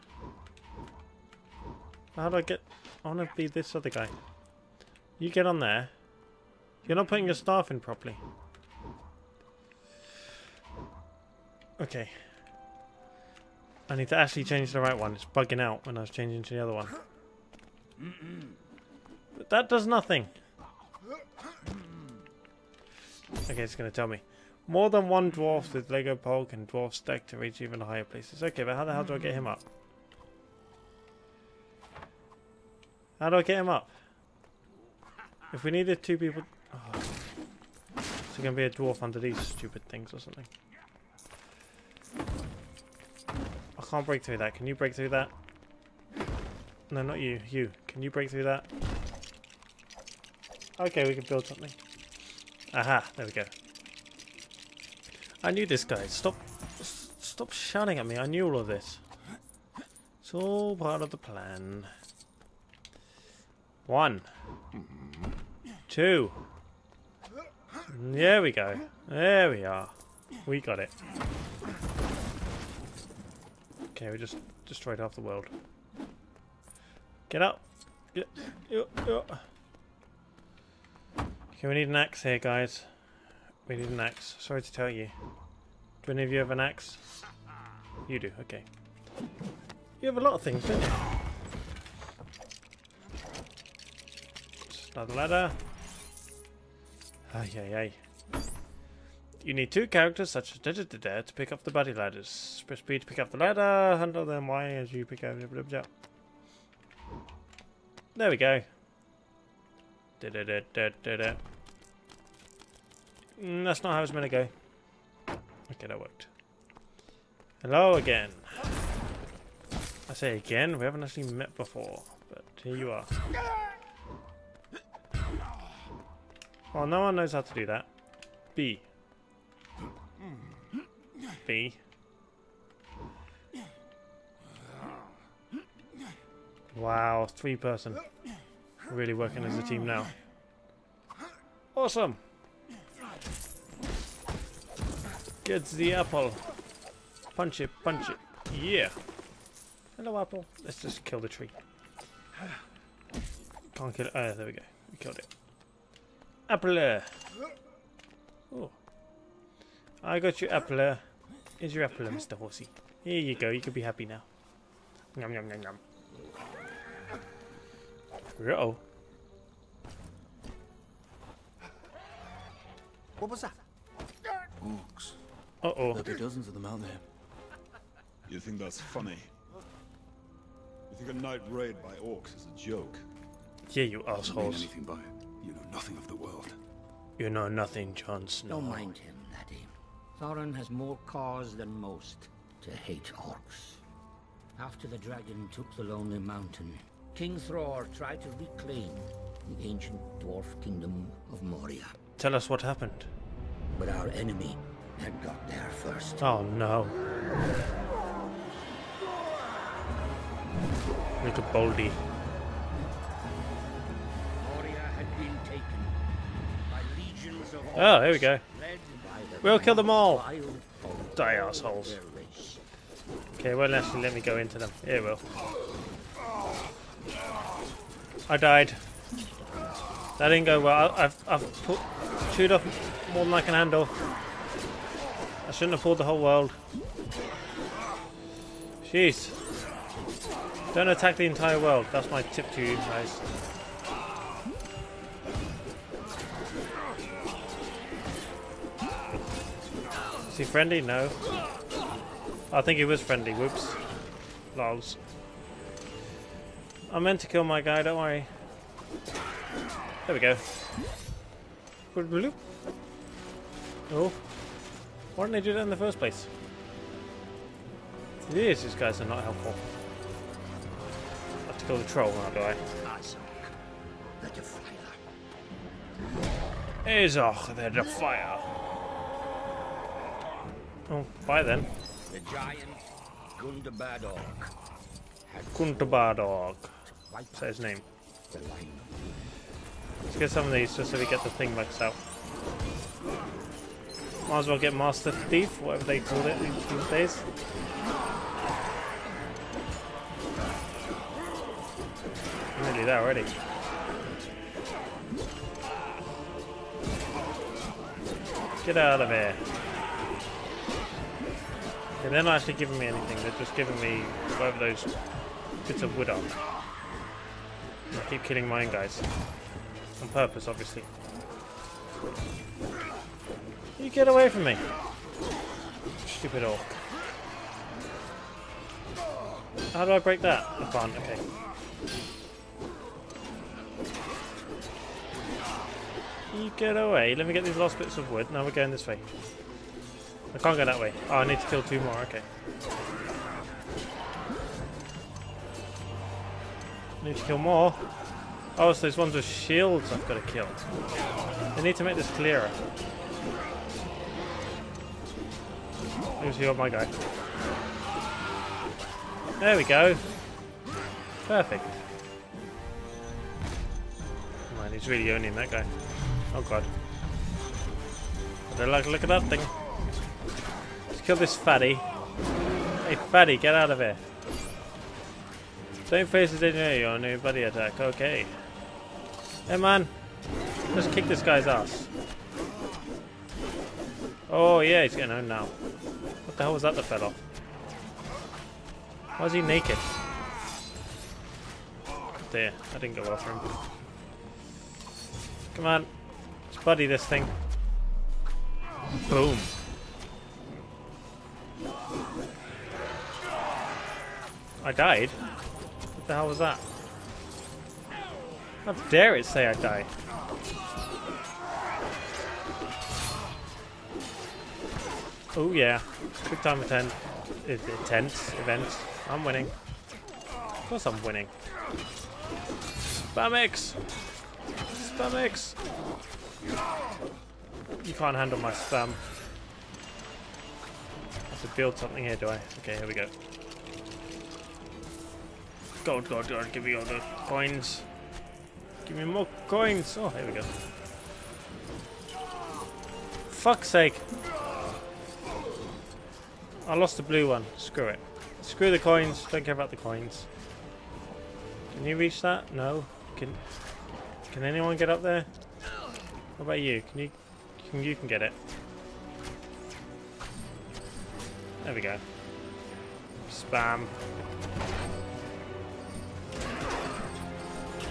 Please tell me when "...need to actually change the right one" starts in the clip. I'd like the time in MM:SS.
00:13.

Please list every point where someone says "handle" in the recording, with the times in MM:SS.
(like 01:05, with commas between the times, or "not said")
01:43, 03:53, 07:08.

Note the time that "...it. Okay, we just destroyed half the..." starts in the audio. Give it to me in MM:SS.
01:10.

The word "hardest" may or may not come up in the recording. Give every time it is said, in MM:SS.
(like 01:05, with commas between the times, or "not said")
not said.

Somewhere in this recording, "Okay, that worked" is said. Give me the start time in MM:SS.
01:55.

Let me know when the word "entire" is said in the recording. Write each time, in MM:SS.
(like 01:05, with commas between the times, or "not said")
04:01.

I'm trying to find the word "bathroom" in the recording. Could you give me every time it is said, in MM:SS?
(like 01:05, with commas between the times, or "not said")
not said.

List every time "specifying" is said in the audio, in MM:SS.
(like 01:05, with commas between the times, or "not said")
not said.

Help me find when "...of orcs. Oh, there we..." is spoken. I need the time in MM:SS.
03:37.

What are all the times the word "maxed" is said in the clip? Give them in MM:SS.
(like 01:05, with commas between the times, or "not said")
04:51.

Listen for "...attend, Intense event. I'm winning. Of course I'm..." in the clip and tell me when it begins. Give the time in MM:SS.
06:56.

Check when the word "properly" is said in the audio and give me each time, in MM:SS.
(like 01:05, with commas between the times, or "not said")
00:07.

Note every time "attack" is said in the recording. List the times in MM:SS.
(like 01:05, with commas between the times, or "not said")
04:00, 06:17.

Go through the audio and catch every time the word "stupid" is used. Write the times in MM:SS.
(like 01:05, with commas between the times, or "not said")
00:39, 05:26.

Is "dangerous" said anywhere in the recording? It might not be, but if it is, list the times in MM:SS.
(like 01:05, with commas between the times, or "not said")
not said.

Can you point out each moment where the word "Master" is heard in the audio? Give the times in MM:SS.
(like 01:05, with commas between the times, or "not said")
04:54.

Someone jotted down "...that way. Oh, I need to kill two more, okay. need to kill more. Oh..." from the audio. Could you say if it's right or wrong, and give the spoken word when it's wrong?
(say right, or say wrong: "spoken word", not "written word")
right.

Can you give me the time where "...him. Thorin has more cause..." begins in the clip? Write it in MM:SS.
03:08.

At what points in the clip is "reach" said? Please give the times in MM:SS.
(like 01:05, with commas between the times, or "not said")
00:27, 07:31.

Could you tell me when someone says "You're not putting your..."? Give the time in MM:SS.
00:06.